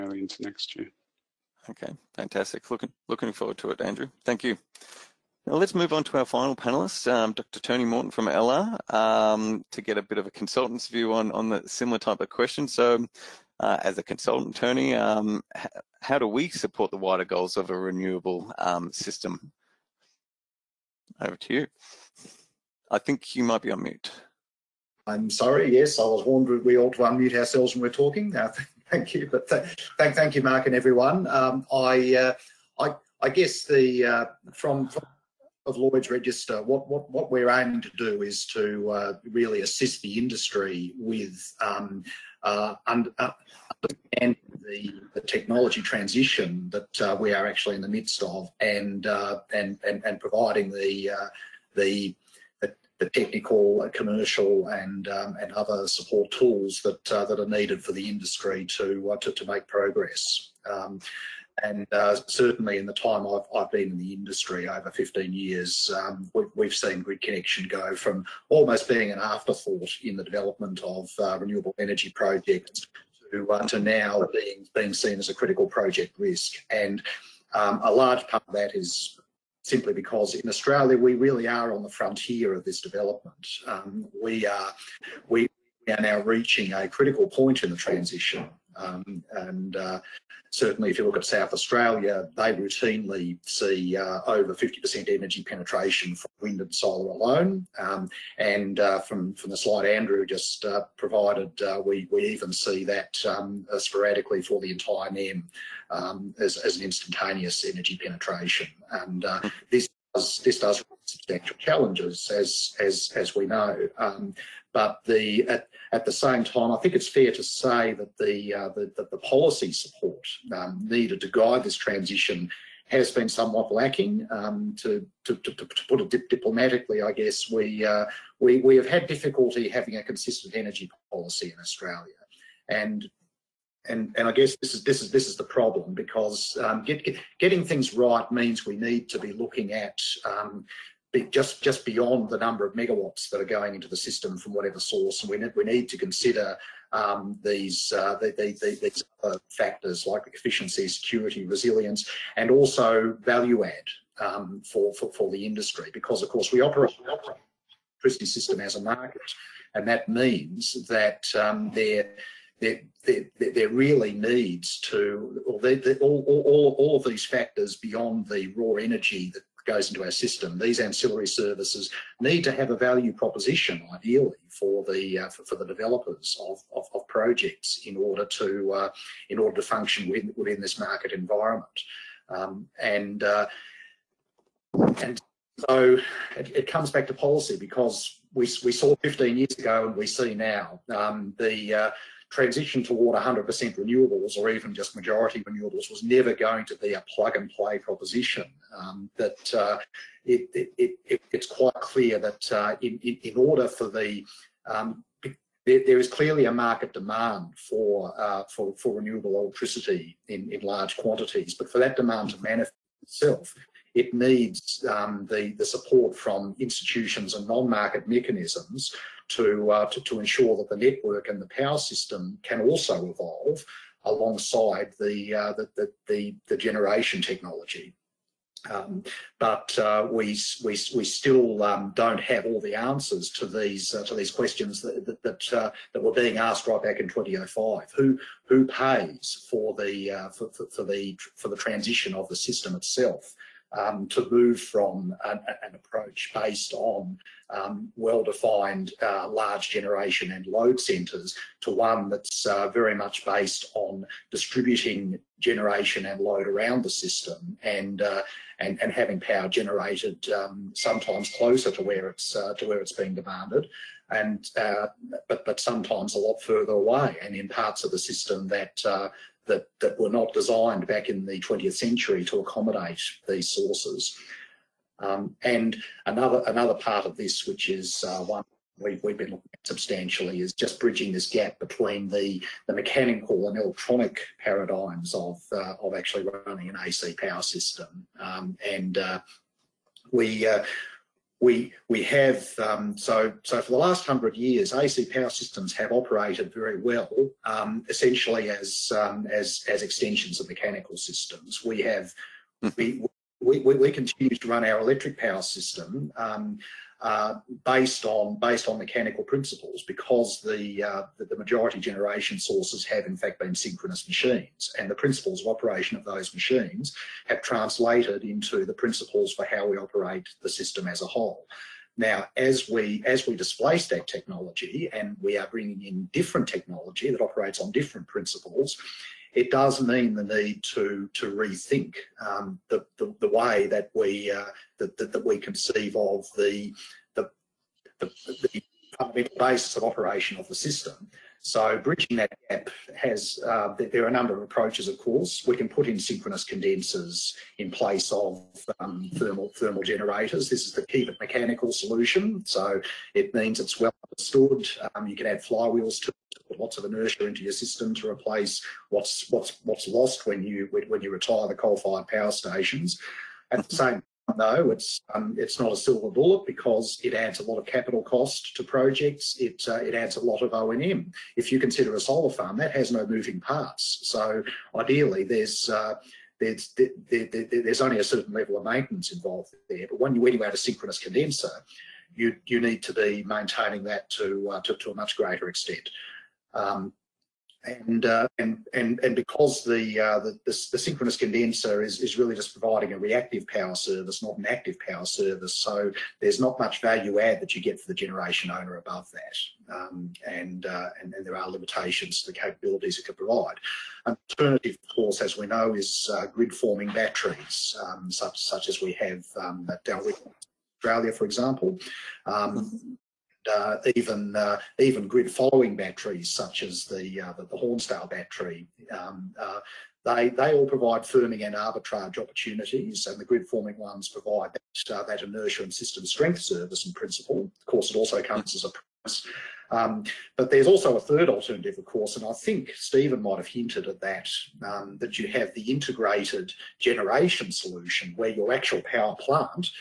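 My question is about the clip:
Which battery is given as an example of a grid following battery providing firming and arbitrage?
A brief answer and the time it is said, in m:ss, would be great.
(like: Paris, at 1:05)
Hornsdale battery, at 6:57.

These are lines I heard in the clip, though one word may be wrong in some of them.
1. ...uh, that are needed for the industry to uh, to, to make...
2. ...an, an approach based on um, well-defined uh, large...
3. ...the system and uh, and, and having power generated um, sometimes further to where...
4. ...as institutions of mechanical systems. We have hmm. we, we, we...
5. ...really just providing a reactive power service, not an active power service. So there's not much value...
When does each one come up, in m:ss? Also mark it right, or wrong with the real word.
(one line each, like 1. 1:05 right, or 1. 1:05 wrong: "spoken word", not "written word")
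1. 0:57 right
2. 4:05 right
3. 4:16 wrong: "closer", not "further"
4. 4:59 wrong: "extensions", not "institutions"
5. 6:32 right.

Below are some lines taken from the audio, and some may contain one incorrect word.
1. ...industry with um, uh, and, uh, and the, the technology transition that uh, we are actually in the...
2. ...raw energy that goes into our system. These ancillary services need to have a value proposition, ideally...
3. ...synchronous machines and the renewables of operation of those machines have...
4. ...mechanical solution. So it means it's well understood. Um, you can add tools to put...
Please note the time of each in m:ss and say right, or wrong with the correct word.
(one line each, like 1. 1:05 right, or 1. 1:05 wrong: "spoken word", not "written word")
1. 0:40 right
2. 2:48 right
3. 5:13 wrong: "principles", not "renewables"
4. 5:51 wrong: "flywheels", not "tools".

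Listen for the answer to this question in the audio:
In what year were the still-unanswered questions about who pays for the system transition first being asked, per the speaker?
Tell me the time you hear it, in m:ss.
3:57.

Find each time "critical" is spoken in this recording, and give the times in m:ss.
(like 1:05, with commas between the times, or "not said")
1:15, 1:26.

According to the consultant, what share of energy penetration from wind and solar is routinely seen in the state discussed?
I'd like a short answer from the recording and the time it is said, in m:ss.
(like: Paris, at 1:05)
over 50%, at 1:34.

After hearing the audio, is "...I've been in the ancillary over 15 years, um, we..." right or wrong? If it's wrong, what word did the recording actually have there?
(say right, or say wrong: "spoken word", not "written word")
wrong: "industry", not "ancillary".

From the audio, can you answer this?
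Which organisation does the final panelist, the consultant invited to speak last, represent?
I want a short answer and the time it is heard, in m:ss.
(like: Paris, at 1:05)
Lloyd's Register, at 0:35.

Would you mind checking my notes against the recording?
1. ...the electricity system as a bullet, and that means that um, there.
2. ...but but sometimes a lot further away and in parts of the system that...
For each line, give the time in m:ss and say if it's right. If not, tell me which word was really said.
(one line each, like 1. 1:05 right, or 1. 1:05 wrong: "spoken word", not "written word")
1. 2:36 wrong: "market", not "bullet"
2. 4:25 right.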